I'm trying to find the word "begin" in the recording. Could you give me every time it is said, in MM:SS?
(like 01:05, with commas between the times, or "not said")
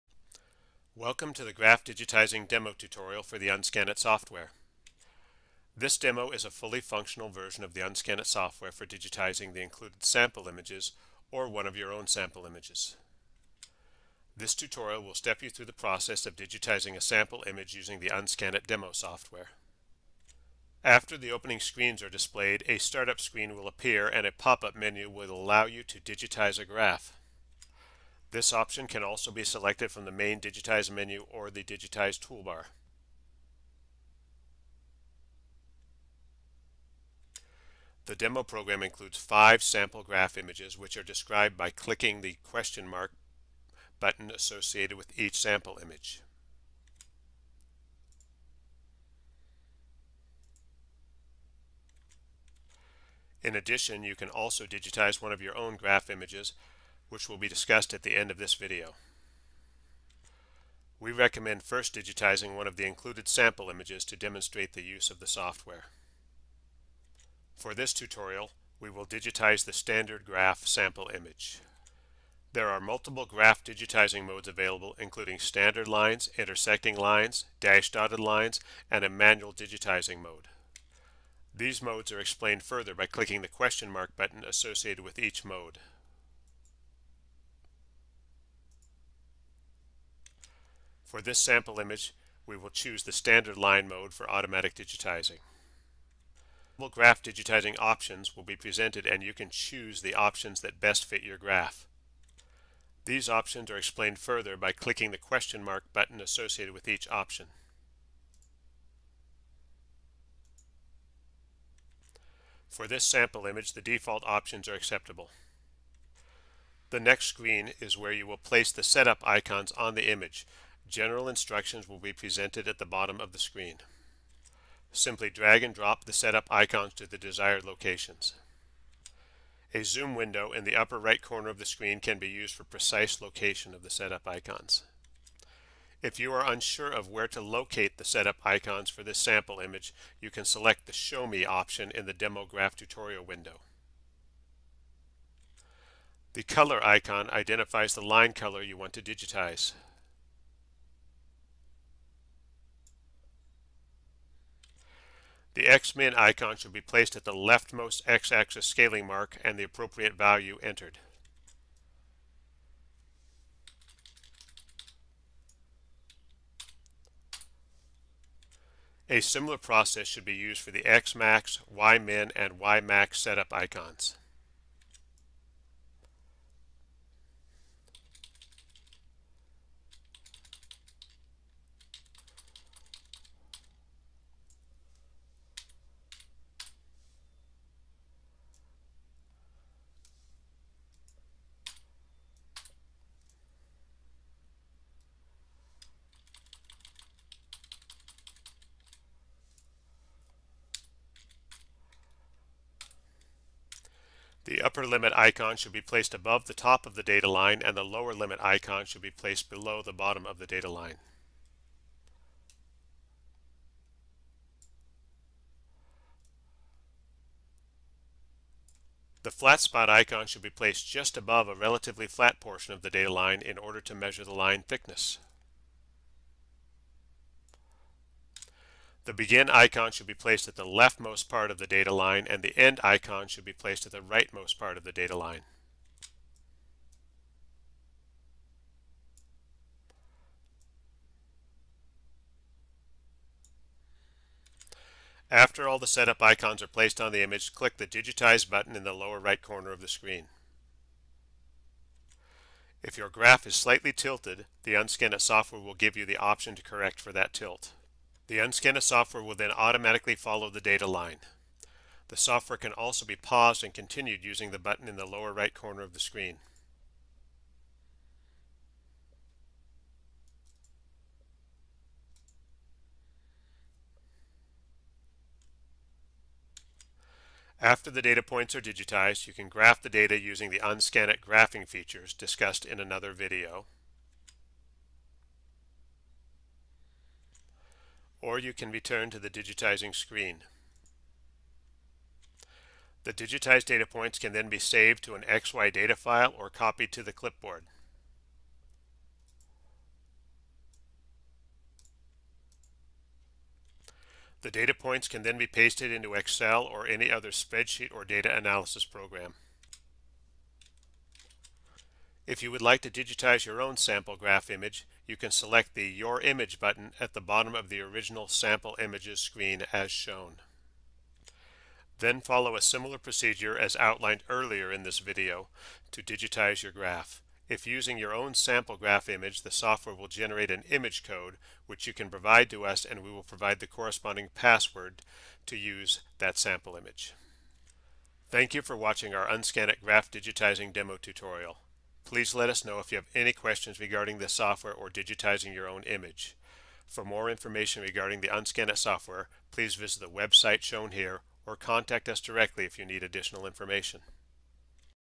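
03:49.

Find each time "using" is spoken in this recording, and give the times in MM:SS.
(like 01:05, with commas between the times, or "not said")
00:17, 04:24, 04:40, 05:27.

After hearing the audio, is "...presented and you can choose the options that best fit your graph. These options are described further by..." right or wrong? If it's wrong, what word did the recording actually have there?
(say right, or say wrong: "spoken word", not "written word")
wrong: "explained", not "described".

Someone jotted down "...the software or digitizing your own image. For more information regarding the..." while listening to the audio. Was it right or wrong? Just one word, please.
right.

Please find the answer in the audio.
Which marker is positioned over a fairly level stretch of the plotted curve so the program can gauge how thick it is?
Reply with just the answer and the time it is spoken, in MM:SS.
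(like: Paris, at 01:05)
flat spot icon, at 03:39.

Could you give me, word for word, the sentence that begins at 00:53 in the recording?
In addition, you can also digitize one of your own graph images which will be discussed at the end of this video.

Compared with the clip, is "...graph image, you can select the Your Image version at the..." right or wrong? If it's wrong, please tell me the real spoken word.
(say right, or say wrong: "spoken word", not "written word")
wrong: "button", not "version".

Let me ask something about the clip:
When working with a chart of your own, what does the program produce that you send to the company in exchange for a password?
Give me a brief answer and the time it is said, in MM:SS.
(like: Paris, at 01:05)
image code, at 05:30.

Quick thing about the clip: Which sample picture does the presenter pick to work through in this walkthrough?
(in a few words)
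standard graph.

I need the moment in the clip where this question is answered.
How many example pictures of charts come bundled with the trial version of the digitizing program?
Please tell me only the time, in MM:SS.
00:39.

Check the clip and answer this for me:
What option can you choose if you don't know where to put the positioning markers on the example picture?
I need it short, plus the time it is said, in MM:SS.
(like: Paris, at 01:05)
Show Me, at 02:20.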